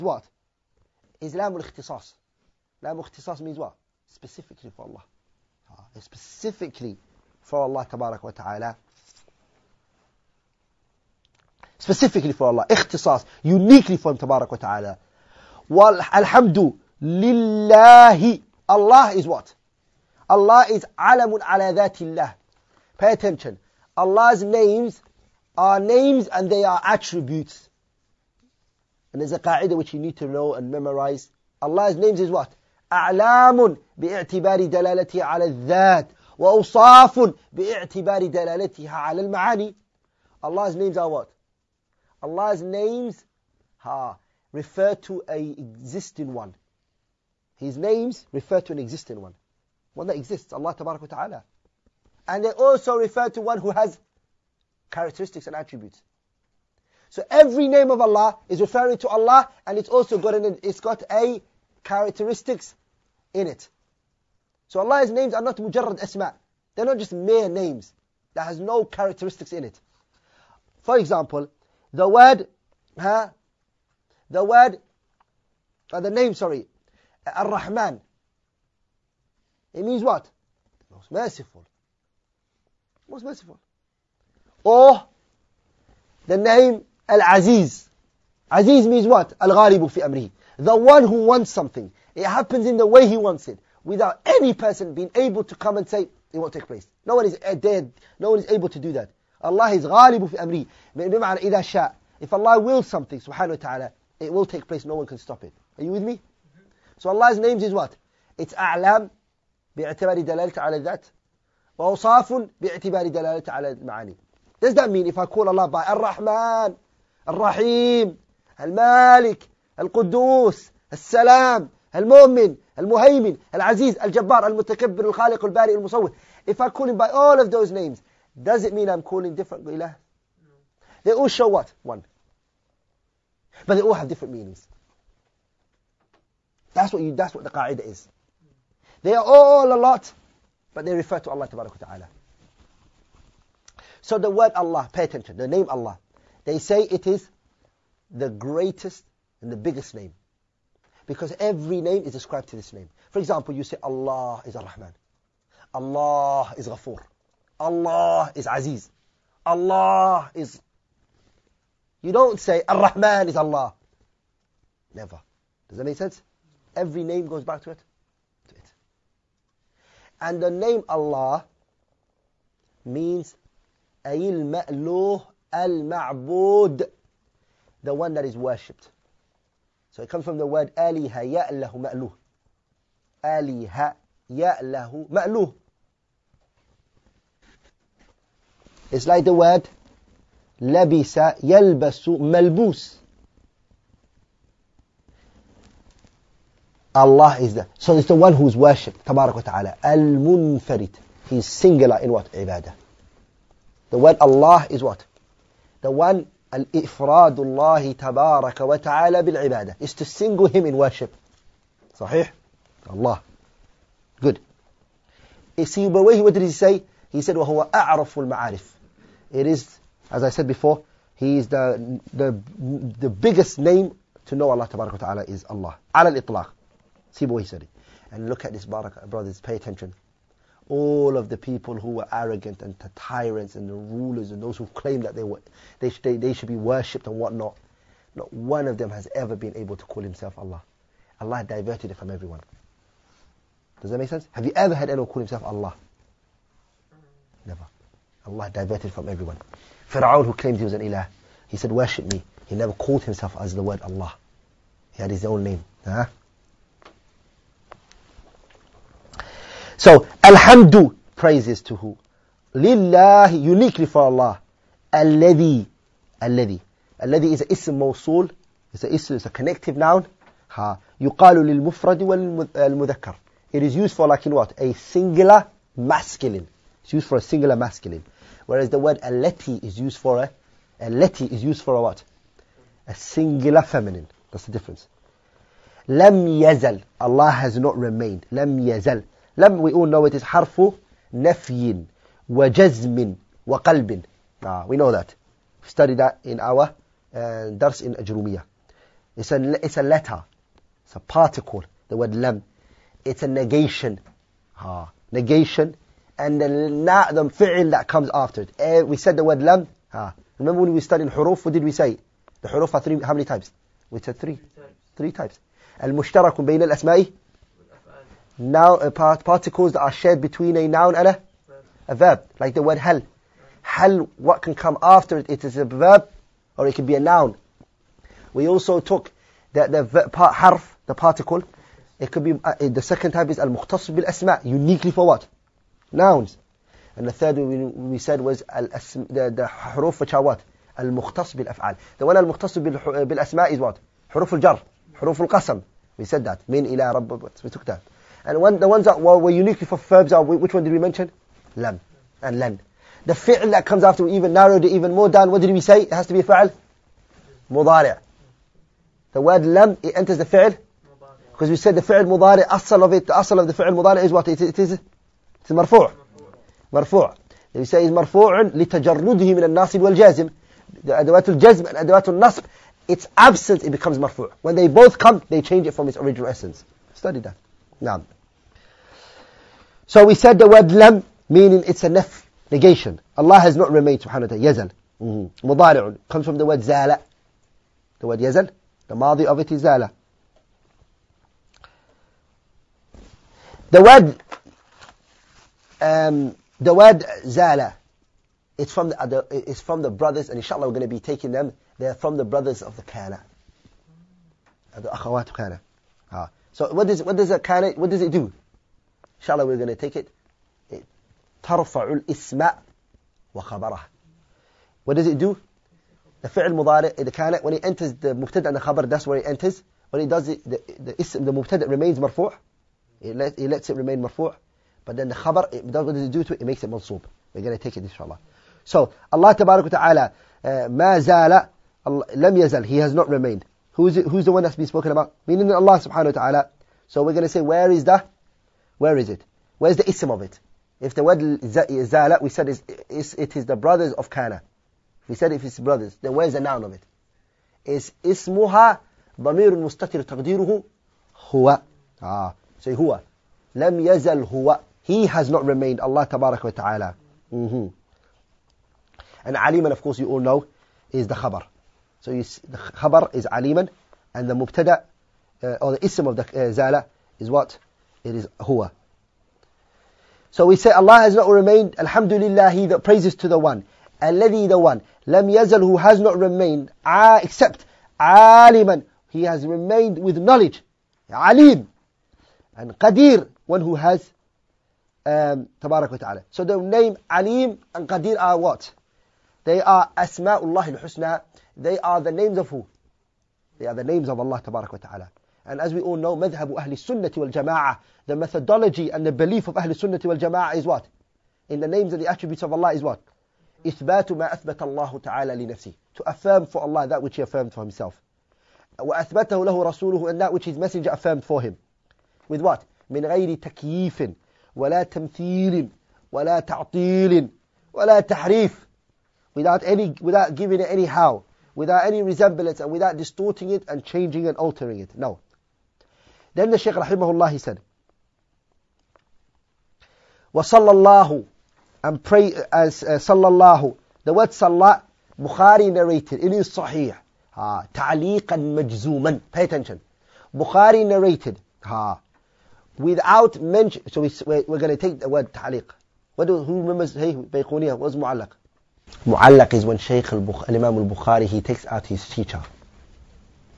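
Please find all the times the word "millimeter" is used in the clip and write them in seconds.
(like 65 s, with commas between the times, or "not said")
not said.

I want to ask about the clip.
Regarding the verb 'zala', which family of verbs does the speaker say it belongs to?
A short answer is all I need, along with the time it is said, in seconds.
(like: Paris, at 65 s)
akhawat kana, at 404 s.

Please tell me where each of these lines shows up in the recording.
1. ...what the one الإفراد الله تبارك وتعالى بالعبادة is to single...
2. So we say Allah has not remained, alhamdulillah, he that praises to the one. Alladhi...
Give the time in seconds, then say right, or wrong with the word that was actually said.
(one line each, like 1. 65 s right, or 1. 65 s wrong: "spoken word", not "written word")
1. 204 s right
2. 470 s right.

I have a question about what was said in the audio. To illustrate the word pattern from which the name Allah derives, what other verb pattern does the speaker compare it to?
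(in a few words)
labisa yalbasu malbus.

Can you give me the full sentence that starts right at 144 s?
So the word Allah, pay attention, the name Allah, they say it is the greatest and the biggest name.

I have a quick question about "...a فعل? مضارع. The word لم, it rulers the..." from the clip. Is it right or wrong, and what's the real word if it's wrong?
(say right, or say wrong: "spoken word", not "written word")
wrong: "enters", not "rulers".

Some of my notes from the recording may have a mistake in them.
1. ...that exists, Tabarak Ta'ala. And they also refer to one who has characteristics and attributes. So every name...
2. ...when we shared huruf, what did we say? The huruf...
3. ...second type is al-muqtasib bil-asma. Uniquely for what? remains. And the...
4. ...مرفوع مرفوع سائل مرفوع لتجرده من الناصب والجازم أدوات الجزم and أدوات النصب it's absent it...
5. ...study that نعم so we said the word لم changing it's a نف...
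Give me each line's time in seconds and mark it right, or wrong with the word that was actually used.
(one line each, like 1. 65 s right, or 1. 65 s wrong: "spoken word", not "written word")
1. 50 s wrong: "Allah", not "Tabarak"
2. 310 s wrong: "studied", not "shared"
3. 332 s wrong: "nouns", not "remains"
4. 365 s right
5. 376 s wrong: "meaning", not "changing".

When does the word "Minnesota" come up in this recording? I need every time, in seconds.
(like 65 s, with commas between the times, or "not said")
not said.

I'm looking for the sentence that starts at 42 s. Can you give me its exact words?
Allah's names ha, refer to an existing one.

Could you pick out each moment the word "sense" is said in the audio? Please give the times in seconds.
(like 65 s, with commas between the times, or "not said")
165 s, 244 s.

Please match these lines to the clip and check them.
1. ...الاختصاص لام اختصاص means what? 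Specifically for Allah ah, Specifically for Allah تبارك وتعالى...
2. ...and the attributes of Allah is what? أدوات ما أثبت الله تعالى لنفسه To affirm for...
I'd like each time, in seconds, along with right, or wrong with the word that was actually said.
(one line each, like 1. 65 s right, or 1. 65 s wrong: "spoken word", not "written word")
1. 1 s right
2. 501 s wrong: "إثبات", not "أدوات".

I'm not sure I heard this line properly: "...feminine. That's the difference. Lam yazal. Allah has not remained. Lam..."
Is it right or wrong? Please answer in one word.
right.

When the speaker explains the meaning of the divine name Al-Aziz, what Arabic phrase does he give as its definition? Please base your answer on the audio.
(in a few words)
Al-Ghalibu fi amrihi.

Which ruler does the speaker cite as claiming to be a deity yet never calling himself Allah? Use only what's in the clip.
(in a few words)
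Fir'aun.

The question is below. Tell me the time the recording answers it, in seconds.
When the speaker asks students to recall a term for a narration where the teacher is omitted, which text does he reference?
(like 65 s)
547 s.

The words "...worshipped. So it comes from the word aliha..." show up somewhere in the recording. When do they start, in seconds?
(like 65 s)
178 s.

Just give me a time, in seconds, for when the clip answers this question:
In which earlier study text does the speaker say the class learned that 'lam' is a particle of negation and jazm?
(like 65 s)
297 s.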